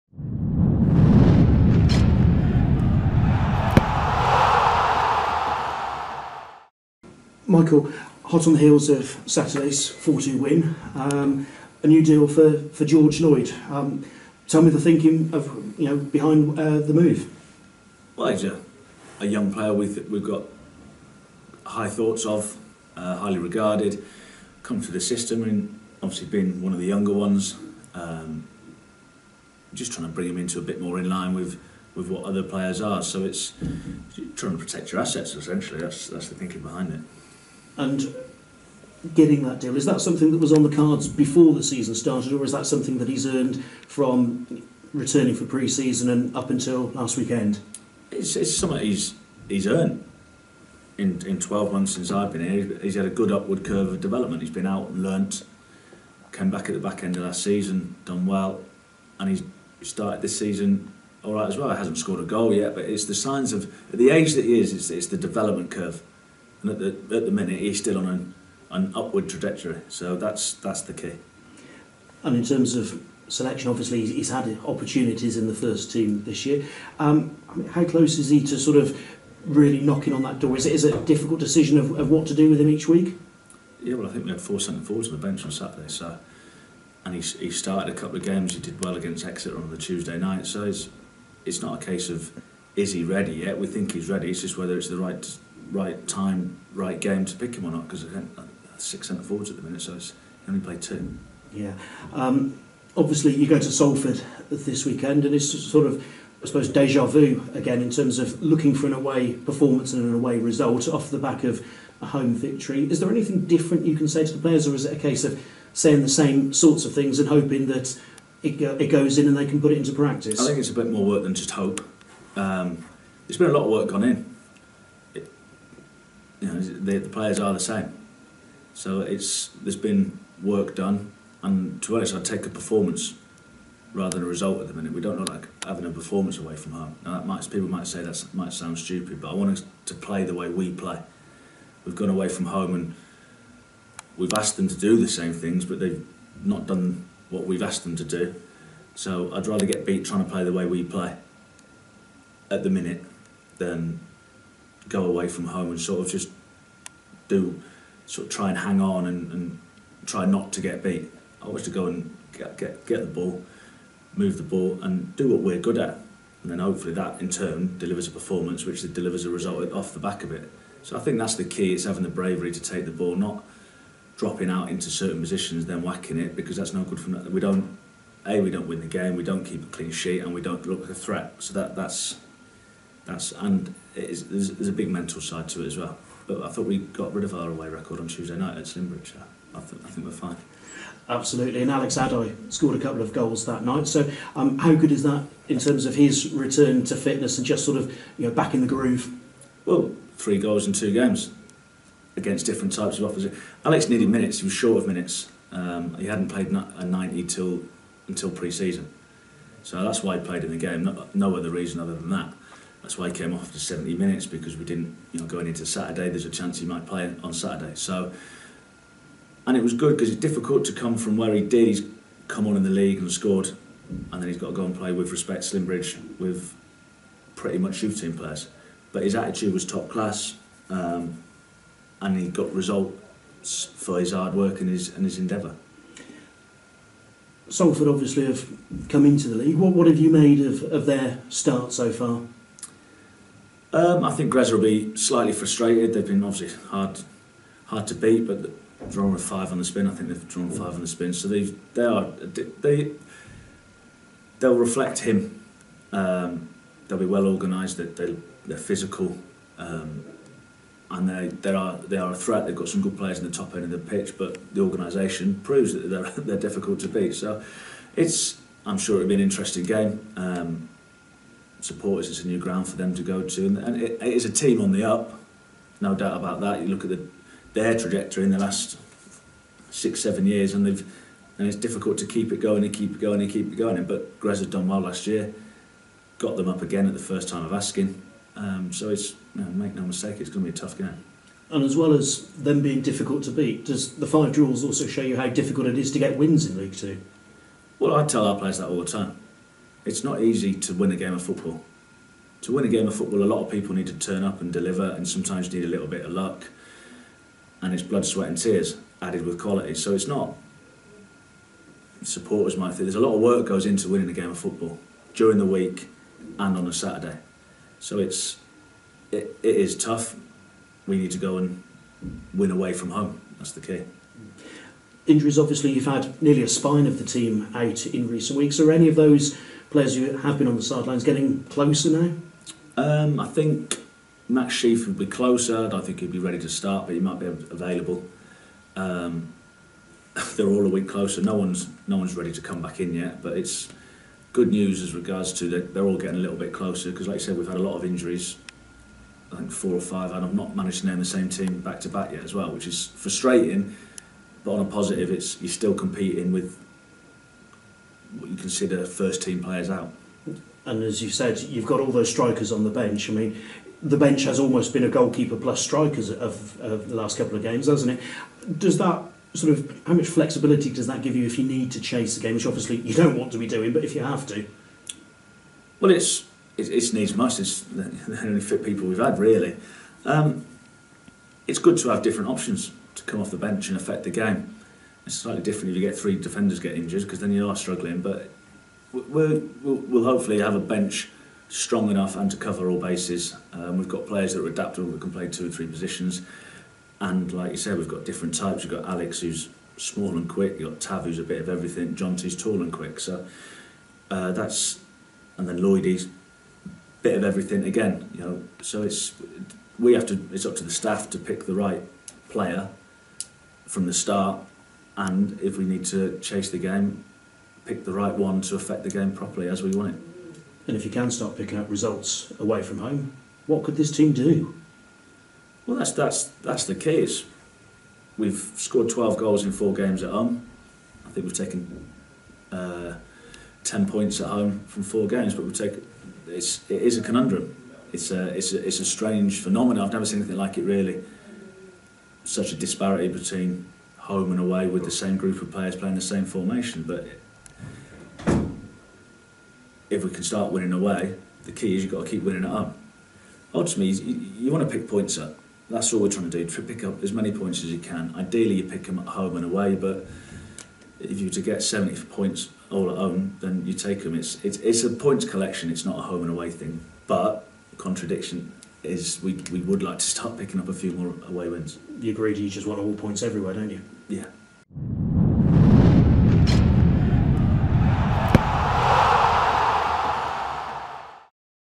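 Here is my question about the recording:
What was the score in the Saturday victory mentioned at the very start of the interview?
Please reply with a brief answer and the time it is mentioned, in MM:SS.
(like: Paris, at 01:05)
4-2, at 00:09.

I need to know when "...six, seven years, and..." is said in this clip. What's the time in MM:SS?
04:39.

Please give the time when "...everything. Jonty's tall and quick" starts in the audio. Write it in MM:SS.
06:41.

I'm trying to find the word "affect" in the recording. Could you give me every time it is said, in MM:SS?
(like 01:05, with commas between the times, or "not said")
06:23, 06:58.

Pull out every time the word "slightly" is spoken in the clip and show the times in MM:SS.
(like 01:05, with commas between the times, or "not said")
04:04, 06:25.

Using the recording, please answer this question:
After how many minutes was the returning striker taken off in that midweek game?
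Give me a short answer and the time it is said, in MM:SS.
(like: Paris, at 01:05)
70, at 03:33.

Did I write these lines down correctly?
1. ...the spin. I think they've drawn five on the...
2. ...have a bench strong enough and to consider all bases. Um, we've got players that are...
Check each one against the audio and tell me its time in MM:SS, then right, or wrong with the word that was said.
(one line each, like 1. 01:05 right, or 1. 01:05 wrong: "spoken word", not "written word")
1. 04:09 right
2. 06:30 wrong: "cover", not "consider".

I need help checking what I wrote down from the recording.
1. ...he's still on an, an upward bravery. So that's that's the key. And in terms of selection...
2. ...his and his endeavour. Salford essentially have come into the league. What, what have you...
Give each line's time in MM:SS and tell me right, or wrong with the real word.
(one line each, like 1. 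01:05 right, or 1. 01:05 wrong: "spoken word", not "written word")
1. 01:07 wrong: "trajectory", not "bravery"
2. 03:54 wrong: "obviously", not "essentially".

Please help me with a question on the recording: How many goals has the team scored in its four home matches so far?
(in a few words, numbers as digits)
12.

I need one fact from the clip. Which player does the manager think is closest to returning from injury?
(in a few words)
Max Sheaf.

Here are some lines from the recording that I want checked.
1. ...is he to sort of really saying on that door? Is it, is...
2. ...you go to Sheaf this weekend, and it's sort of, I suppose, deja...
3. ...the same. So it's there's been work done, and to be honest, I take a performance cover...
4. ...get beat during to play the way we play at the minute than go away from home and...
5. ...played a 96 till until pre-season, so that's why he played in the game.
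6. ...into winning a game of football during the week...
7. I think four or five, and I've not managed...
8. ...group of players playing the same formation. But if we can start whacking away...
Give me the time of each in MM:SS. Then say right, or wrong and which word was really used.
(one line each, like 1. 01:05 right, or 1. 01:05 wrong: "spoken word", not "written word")
1. 01:18 wrong: "knocking", not "saying"
2. 01:43 wrong: "Salford", not "Sheaf"
3. 02:07 wrong: "rather", not "cover"
4. 02:29 wrong: "trying", not "during"
5. 03:26 wrong: "90", not "96"
6. 05:13 right
7. 05:49 right
8. 07:25 wrong: "winning", not "whacking".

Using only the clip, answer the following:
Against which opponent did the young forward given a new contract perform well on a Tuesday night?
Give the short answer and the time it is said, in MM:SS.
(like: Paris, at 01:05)
Exeter, at 01:29.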